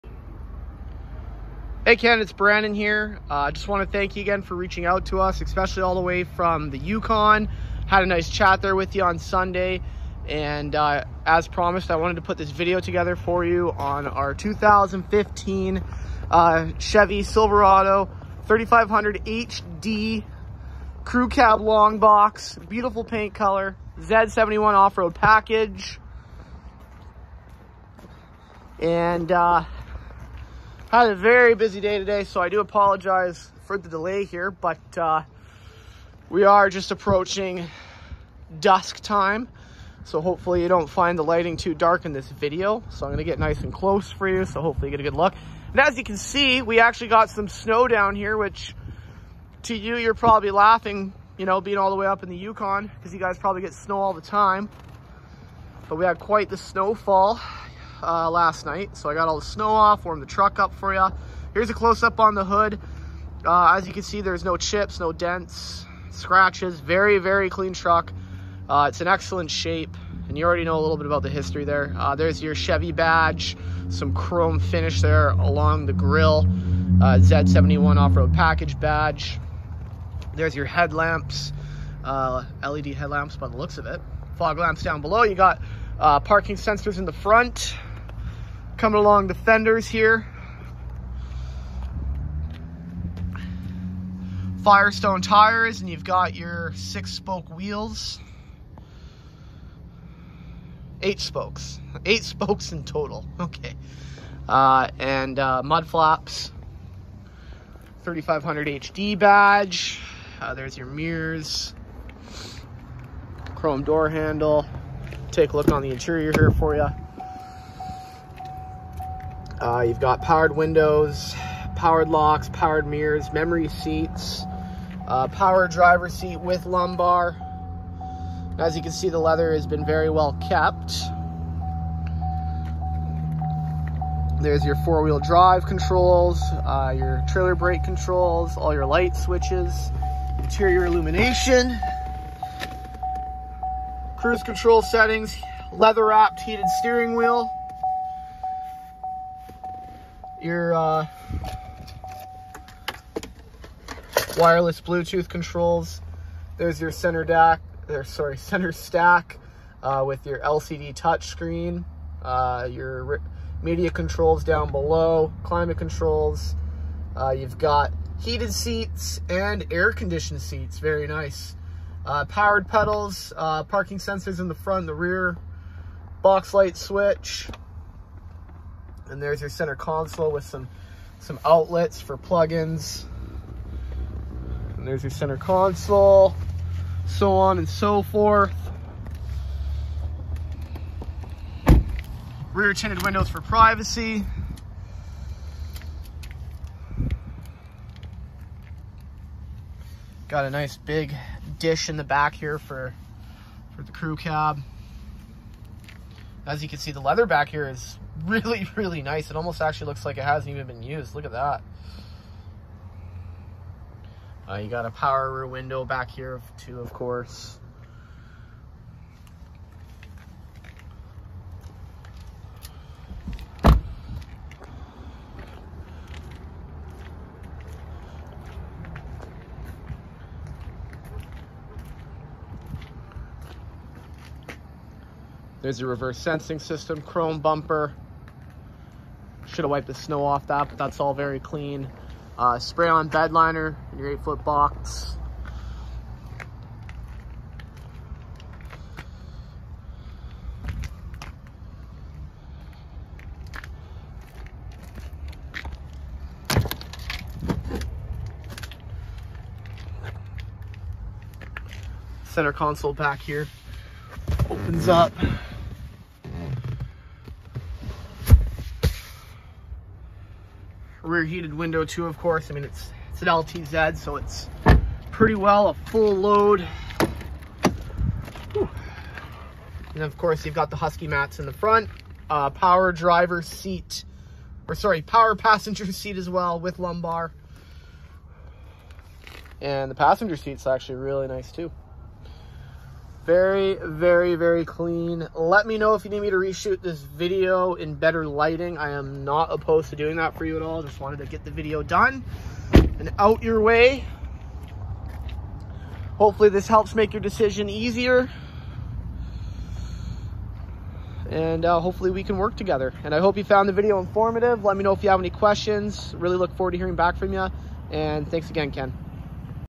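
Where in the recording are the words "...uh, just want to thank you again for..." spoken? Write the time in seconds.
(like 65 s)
3 s.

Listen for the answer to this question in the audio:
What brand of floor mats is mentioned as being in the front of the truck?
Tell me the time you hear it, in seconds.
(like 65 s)
280 s.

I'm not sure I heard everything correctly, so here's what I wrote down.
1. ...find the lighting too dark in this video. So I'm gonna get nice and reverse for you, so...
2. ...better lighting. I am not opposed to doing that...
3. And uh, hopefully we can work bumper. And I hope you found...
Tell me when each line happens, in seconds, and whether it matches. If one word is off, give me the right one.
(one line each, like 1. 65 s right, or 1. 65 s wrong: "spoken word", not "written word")
1. 40 s wrong: "close", not "reverse"
2. 297 s right
3. 311 s wrong: "together", not "bumper".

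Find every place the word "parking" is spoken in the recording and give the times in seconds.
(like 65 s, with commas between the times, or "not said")
86 s, 173 s.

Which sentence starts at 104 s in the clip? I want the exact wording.
Uh, and uh, mud flaps, 3500 HD badge.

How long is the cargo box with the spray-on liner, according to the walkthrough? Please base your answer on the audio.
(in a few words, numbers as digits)
8 feet.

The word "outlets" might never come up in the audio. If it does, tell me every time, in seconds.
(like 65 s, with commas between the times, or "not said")
181 s.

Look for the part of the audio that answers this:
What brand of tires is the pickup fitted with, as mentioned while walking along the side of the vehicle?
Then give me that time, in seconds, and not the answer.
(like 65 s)
94 s.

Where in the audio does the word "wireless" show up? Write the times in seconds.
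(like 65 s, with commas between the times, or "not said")
154 s.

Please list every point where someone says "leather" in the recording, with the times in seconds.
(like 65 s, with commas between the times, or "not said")
129 s, 145 s, 207 s.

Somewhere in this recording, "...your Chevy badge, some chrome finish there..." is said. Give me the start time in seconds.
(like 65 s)
72 s.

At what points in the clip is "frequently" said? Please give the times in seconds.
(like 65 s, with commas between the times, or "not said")
not said.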